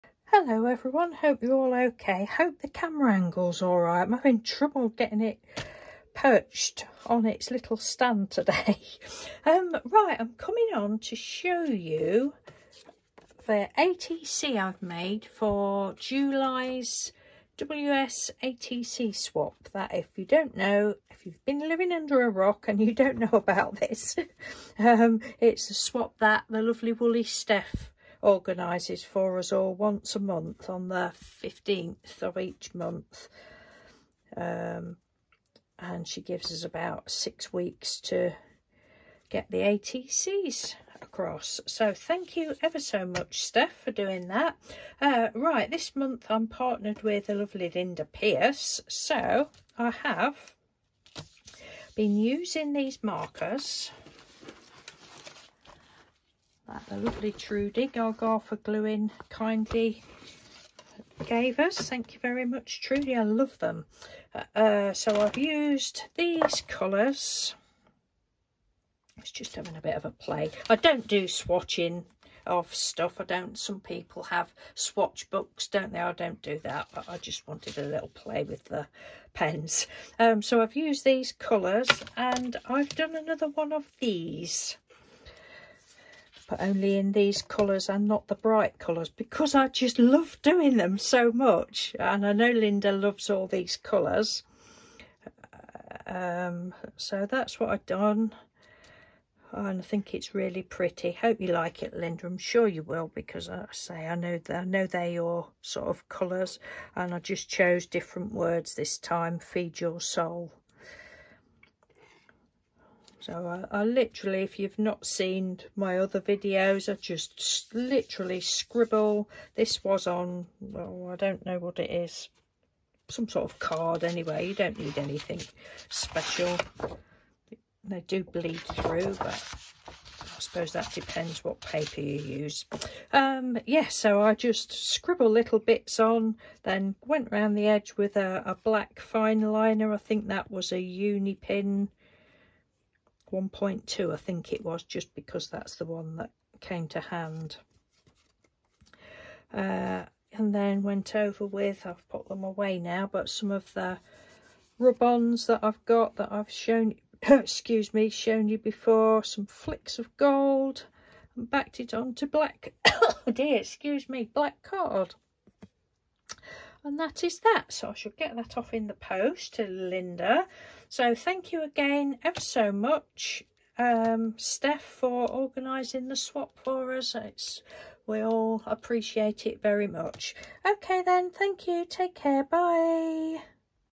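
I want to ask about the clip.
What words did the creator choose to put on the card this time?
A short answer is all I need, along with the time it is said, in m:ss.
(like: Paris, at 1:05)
Feed your soul, at 1:49.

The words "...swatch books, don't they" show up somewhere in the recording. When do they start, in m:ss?
1:14.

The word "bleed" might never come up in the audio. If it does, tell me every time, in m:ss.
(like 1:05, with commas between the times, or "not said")
2:08.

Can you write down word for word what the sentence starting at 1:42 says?
I'm sure you will because, I say, I know, they, I know they're your sort of colours.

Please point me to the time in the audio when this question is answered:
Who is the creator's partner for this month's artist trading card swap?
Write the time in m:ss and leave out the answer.
0:47.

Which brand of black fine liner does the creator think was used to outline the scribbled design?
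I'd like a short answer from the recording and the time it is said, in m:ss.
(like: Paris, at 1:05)
Uni pin, at 2:20.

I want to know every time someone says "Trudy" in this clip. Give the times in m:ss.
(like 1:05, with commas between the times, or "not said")
0:57, 1:02.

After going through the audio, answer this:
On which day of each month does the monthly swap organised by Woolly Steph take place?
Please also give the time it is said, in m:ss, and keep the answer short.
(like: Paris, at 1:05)
15th, at 0:30.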